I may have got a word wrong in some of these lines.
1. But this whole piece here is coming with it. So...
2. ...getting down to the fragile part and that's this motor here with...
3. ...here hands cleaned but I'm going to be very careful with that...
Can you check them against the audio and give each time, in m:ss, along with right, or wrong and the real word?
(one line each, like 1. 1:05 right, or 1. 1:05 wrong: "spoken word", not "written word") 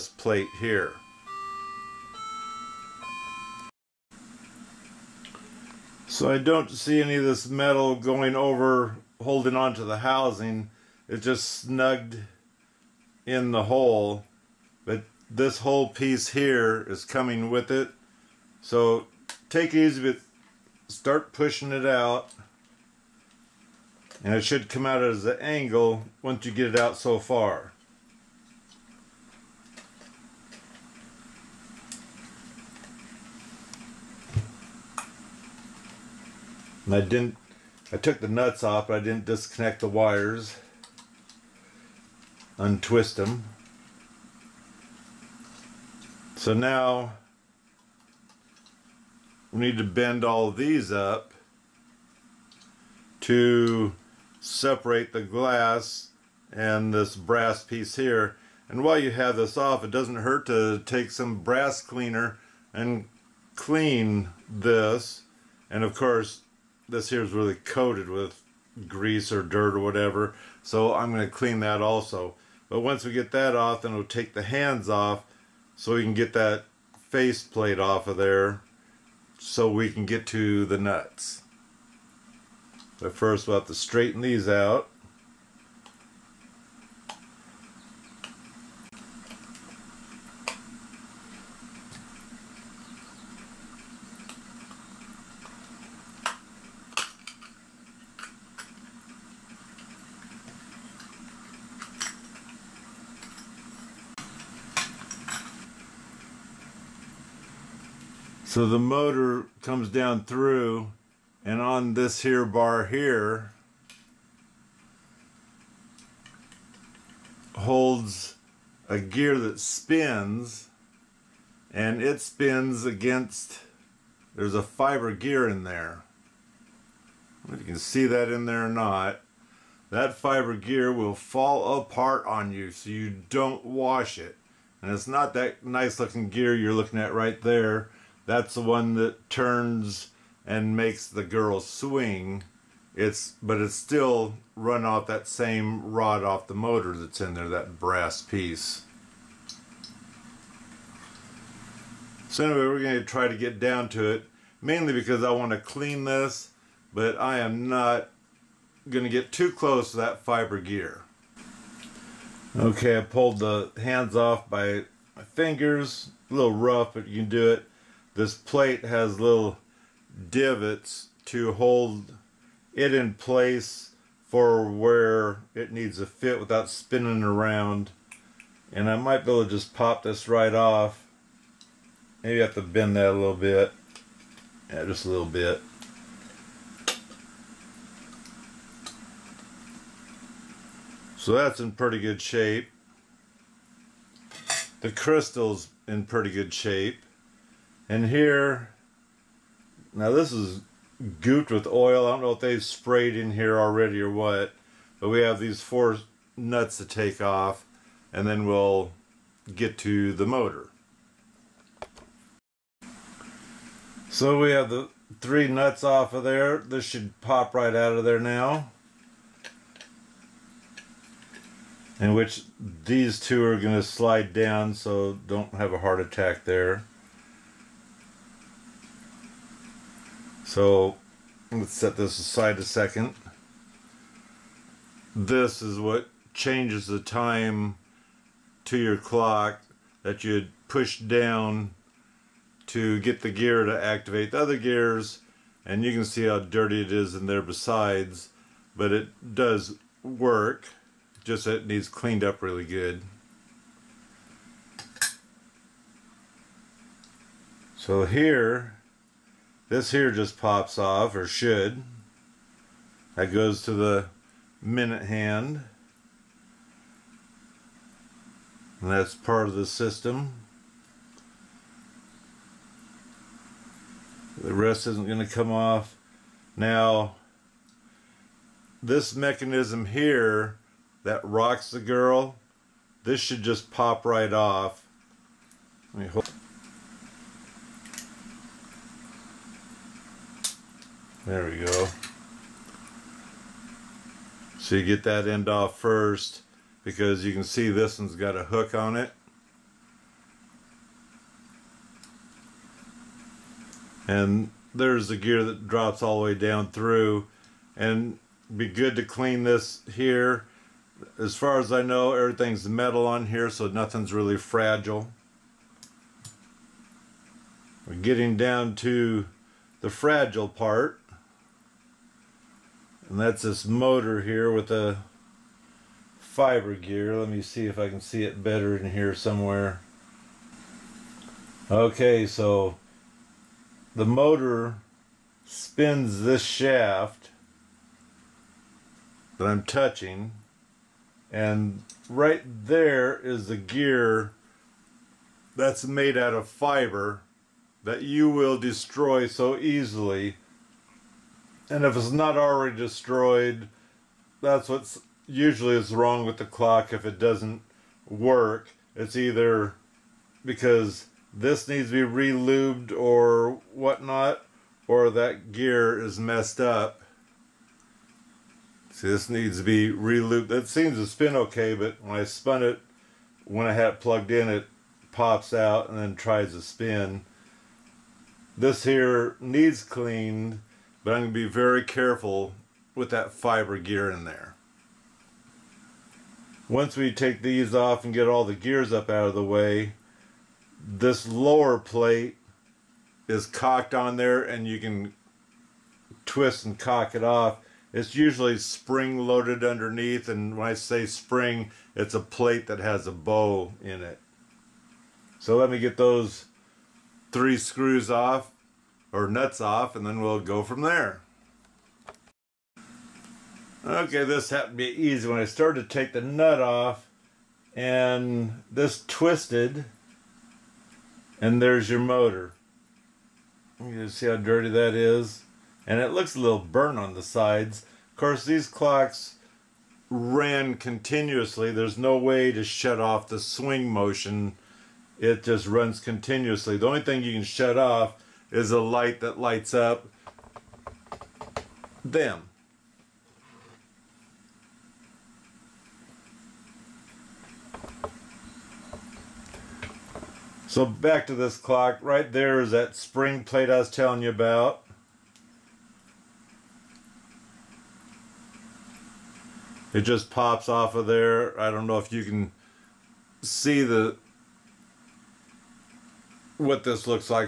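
1. 0:14 right
2. 5:17 right
3. 6:18 wrong: "needs", not "hands".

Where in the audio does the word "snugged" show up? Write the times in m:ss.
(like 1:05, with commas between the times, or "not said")
0:11.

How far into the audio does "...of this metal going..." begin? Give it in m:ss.
0:07.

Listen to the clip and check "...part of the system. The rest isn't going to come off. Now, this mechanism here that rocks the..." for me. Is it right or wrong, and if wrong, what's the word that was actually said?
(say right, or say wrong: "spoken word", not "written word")
right.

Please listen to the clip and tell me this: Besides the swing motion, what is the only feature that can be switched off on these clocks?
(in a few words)
A light.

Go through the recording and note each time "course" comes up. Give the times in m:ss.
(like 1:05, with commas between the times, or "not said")
1:05, 7:08.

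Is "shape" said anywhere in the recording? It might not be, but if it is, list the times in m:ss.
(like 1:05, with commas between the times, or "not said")
3:12, 3:16.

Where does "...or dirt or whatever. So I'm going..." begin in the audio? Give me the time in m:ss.
1:09.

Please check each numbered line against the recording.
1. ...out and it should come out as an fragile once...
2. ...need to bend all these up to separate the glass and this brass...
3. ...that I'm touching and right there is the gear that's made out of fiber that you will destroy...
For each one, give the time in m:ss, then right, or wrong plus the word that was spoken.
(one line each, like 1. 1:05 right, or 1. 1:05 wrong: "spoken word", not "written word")
1. 0:21 wrong: "angle", not "fragile"
2. 0:49 right
3. 5:39 right.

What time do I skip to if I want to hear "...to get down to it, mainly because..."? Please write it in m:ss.
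2:33.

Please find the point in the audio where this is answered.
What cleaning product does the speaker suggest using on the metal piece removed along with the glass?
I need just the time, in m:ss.
1:01.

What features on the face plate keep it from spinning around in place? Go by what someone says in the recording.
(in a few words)
Little divots.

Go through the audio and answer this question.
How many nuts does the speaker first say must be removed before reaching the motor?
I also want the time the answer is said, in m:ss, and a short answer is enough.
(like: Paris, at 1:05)
4, at 3:25.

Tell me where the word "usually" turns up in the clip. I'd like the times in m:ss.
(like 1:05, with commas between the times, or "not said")
5:55, 6:38.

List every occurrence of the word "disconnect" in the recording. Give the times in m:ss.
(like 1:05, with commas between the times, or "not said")
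0:39.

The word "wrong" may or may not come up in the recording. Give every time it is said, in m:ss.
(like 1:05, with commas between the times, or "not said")
5:55.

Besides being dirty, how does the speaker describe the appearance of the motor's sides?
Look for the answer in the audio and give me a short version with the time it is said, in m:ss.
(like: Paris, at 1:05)
A little burnt, at 7:06.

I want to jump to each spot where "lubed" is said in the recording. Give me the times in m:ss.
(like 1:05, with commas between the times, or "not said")
6:02, 6:09.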